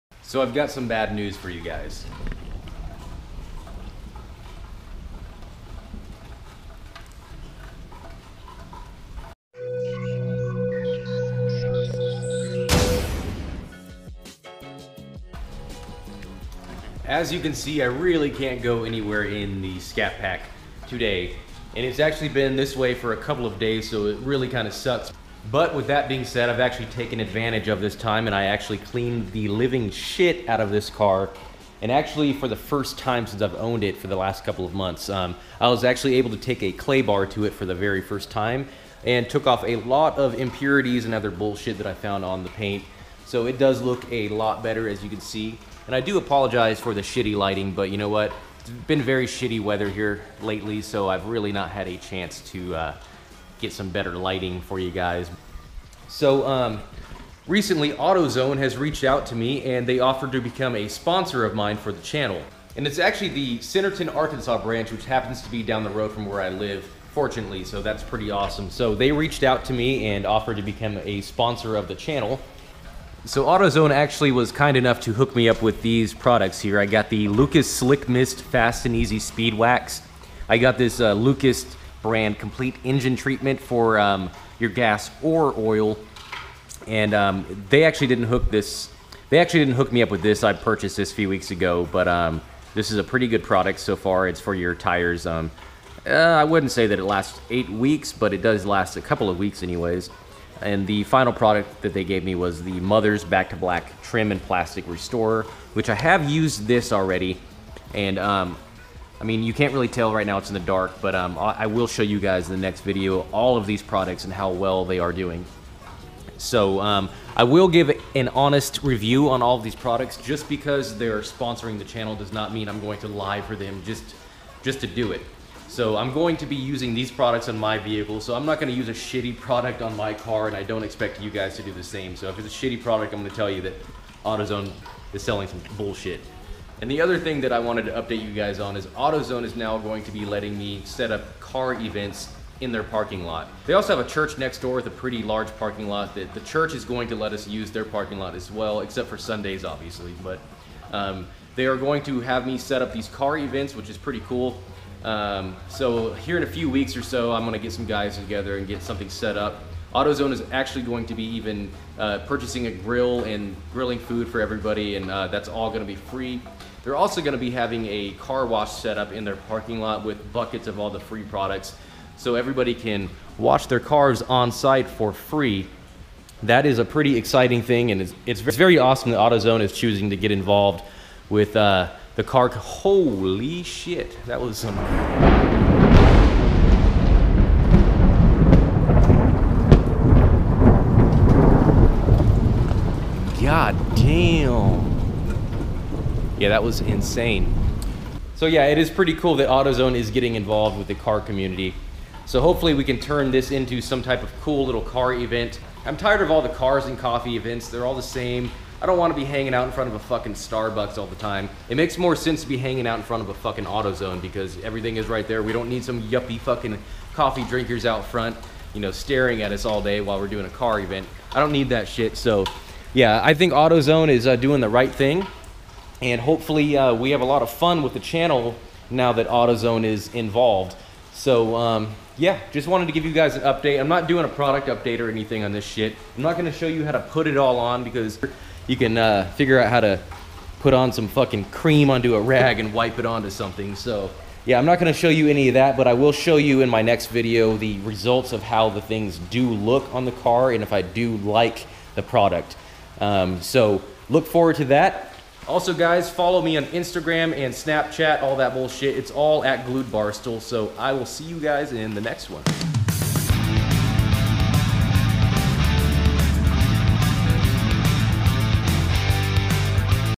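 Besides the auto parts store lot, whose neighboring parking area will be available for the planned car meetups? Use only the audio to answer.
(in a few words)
A church.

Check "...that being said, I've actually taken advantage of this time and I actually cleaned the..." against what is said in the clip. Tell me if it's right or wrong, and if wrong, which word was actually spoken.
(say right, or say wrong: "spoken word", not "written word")
right.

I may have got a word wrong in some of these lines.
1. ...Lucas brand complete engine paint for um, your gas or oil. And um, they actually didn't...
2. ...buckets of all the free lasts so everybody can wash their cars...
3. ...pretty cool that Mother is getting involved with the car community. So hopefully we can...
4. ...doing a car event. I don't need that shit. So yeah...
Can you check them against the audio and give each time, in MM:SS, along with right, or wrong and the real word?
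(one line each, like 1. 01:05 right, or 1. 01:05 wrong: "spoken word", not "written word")
1. 01:21 wrong: "treatment", not "paint"
2. 02:50 wrong: "products", not "lasts"
3. 03:18 wrong: "AutoZone", not "Mother"
4. 03:40 right.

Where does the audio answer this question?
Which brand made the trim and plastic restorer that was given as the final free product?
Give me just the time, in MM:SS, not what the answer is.
01:42.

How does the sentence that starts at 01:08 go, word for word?
So they reached out to me and offered to become a sponsor of the channel.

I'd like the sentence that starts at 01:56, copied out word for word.
So um, I will give an honest review on all of these products.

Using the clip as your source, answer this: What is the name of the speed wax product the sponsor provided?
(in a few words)
Lucas Slick Mist.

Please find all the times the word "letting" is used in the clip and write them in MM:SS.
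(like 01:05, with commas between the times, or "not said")
02:20.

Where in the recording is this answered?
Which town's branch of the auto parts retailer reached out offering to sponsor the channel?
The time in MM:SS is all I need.
01:03.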